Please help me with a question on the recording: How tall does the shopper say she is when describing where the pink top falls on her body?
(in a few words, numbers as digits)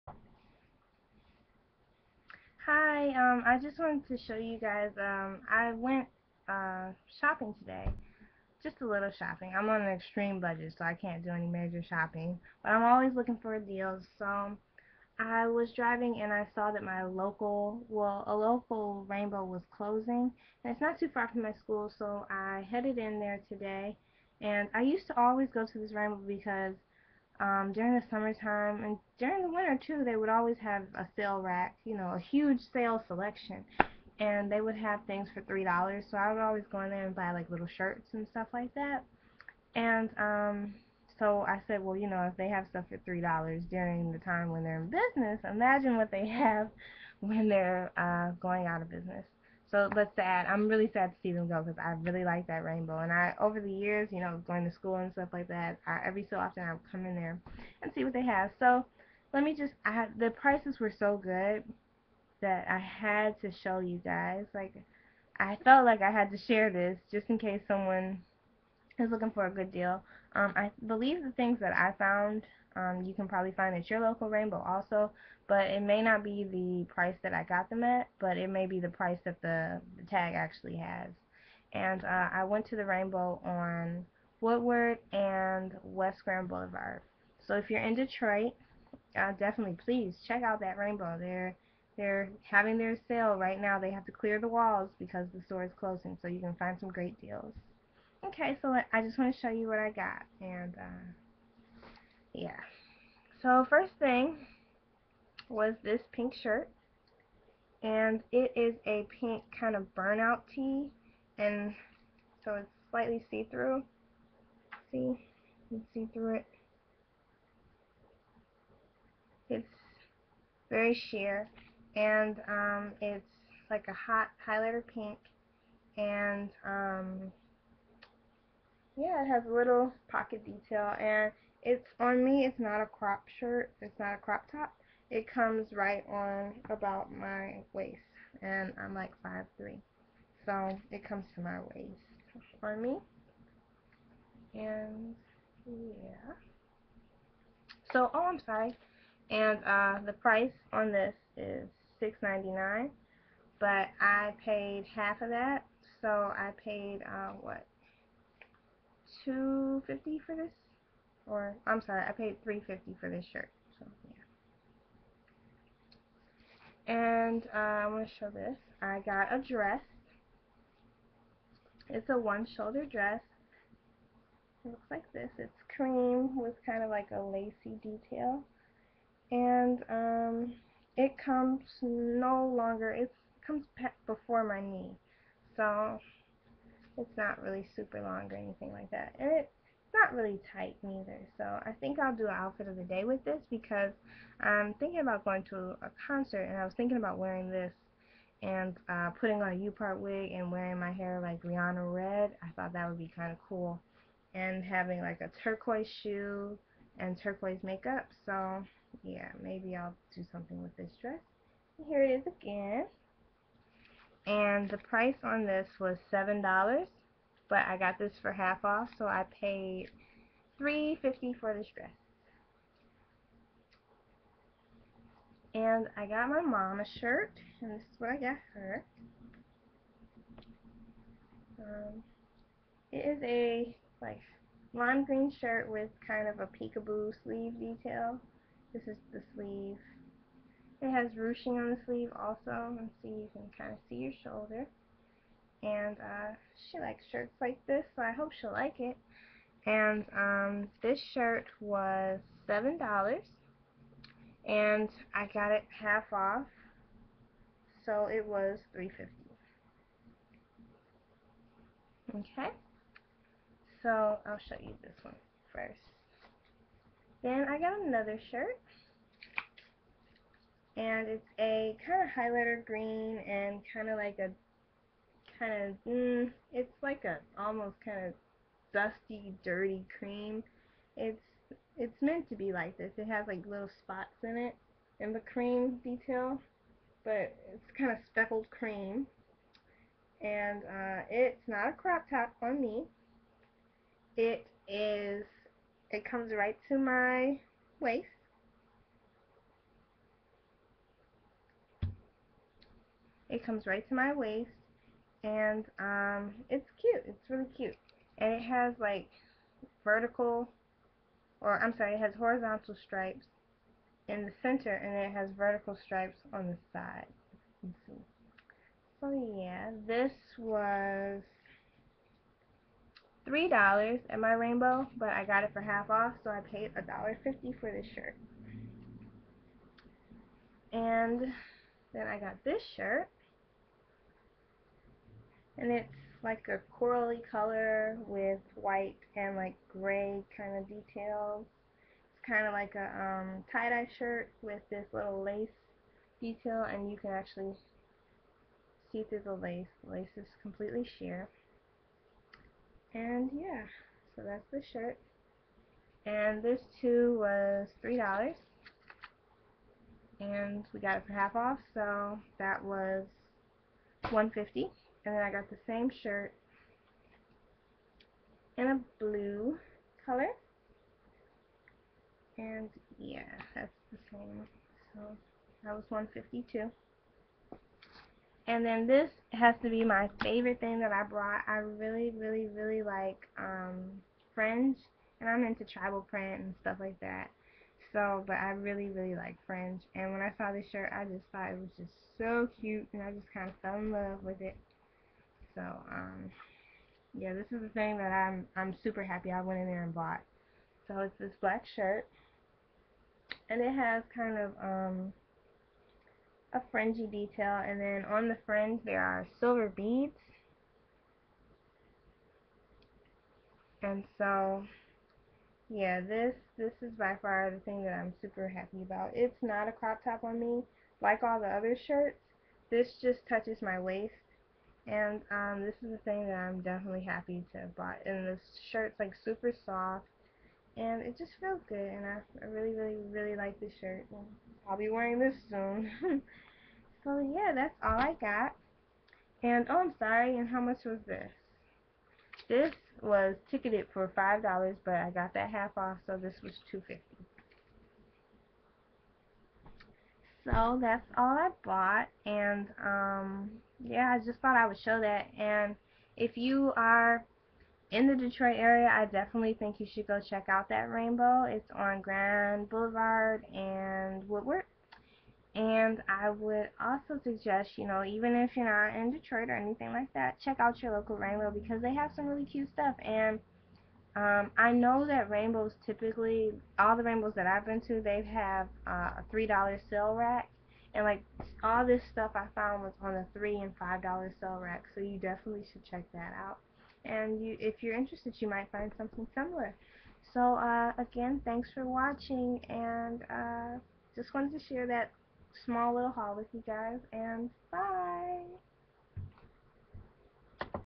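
5'3".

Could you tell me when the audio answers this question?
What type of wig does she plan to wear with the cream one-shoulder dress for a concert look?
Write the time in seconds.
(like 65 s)
199 s.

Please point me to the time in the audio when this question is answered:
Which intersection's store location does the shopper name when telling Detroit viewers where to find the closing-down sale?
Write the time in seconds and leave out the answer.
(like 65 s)
84 s.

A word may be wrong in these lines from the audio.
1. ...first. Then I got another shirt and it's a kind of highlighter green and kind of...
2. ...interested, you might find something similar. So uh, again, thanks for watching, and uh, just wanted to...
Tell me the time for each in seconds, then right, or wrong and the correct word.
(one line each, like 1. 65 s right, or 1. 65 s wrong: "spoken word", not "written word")
1. 265 s right
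2. 487 s right.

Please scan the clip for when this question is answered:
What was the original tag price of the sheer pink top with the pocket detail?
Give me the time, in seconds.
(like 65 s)
151 s.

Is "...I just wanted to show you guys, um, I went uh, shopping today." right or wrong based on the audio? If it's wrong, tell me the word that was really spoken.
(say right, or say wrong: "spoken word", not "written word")
right.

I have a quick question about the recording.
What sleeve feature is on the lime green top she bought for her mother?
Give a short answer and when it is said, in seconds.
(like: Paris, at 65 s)
Peekaboo sleeve, at 236 s.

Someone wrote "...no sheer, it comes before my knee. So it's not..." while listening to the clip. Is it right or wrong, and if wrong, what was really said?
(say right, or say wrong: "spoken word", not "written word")
wrong: "longer", not "sheer".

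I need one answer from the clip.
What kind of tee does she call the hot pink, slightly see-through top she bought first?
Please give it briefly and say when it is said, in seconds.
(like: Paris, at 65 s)
Burnout tee, at 109 s.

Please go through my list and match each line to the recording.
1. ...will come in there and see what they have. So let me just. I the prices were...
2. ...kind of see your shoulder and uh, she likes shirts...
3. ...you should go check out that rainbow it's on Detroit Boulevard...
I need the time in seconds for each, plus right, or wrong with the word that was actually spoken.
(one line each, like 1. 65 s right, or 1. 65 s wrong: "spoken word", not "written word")
1. 56 s right
2. 243 s right
3. 459 s wrong: "Grand", not "Detroit".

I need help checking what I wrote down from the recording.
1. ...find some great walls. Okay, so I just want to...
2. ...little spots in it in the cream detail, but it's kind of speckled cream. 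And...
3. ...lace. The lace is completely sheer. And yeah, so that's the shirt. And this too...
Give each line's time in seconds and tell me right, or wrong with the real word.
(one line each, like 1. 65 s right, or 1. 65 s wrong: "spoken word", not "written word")
1. 96 s wrong: "deals", not "walls"
2. 283 s right
3. 349 s right.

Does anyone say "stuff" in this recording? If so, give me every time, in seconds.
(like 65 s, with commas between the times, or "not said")
38 s, 42 s, 55 s, 386 s, 472 s, 482 s.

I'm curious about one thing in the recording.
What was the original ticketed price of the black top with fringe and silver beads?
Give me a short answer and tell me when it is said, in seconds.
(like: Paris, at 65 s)
$5, at 444 s.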